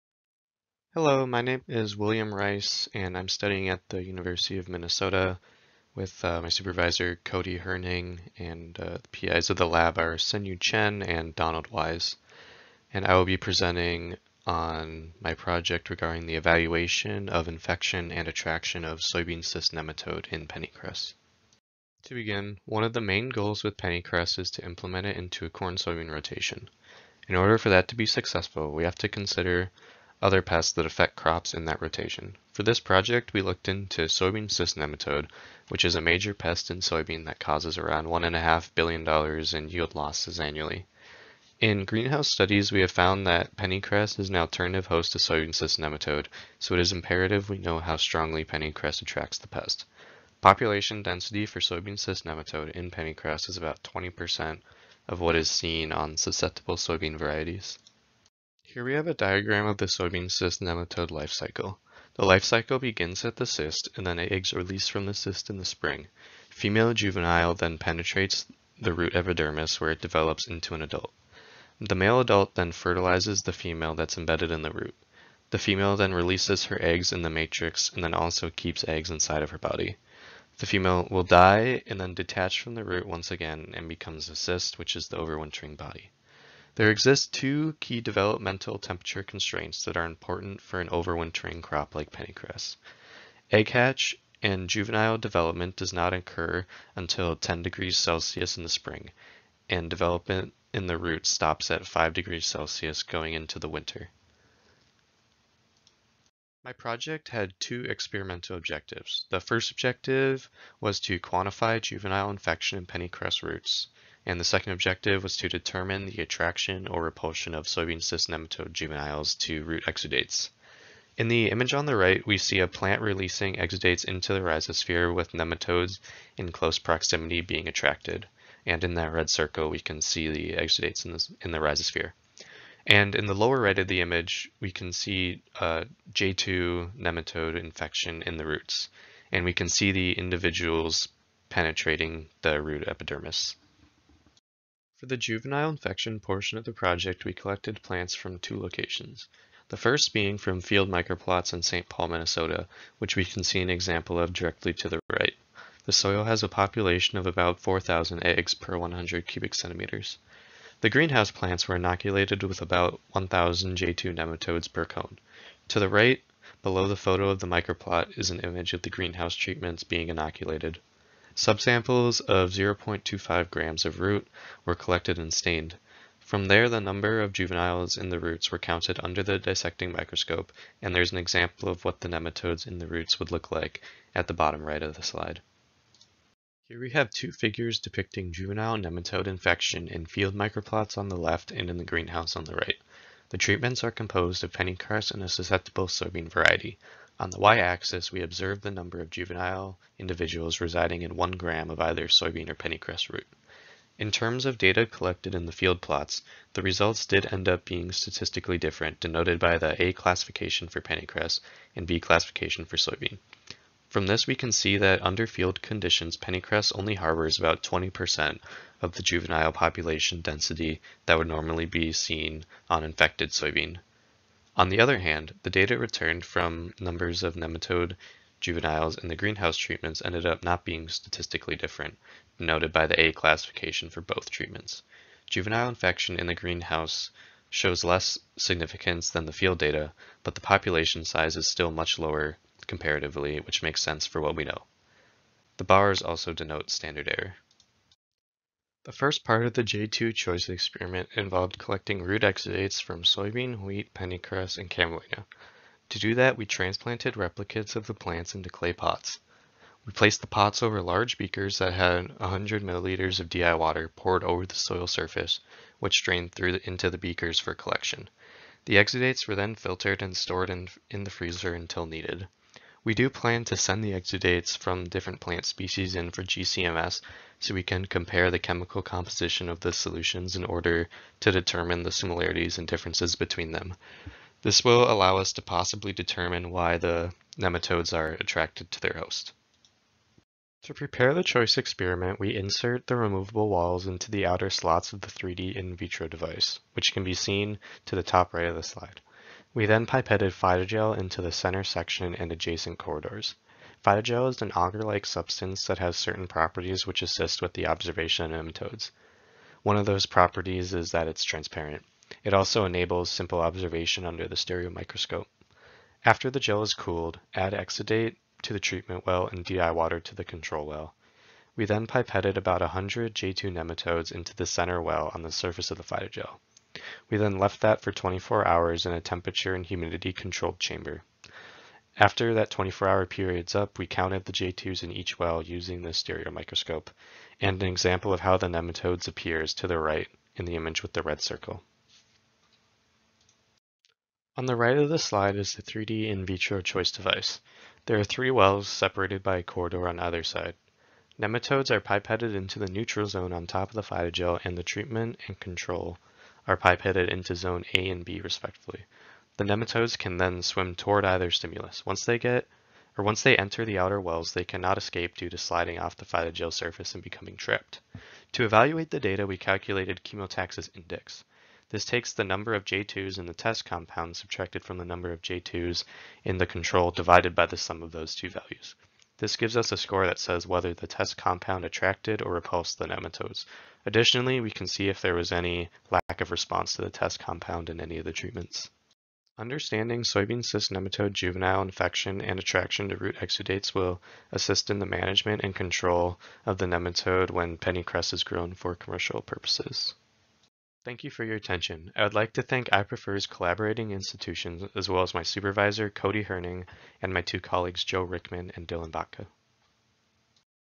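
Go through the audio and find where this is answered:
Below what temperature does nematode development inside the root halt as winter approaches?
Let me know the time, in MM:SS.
01:41.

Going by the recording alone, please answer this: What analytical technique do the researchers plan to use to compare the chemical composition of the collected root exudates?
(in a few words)
GCMS.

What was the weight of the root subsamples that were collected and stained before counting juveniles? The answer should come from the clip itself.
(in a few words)
0.25 grams.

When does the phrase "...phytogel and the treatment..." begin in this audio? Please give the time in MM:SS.
05:53.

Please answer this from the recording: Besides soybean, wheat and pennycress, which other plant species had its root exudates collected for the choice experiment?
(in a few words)
Camelina.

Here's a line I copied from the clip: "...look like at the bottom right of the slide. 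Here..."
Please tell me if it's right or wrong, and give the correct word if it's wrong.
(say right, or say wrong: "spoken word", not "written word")
right.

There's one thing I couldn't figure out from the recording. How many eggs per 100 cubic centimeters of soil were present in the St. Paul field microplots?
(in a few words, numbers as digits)
4,000.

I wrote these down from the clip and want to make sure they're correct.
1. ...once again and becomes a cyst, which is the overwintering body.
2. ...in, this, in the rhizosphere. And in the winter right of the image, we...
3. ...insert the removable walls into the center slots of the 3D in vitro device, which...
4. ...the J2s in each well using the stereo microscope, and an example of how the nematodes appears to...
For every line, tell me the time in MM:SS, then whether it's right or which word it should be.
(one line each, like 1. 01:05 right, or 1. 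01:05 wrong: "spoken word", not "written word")
1. 01:23 right
2. 02:11 wrong: "lower", not "winter"
3. 04:52 wrong: "outer", not "center"
4. 05:34 right.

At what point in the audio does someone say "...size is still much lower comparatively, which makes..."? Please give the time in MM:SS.
04:01.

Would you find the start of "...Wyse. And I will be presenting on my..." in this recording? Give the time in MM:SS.
00:11.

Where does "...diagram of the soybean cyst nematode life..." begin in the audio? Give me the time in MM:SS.
00:59.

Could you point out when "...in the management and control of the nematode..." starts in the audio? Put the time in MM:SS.
06:34.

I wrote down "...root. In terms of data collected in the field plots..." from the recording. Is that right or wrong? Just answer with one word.
right.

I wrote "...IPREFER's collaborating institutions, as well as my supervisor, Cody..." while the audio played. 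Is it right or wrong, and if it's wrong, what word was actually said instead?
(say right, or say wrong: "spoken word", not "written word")
right.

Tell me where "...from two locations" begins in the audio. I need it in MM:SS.
02:28.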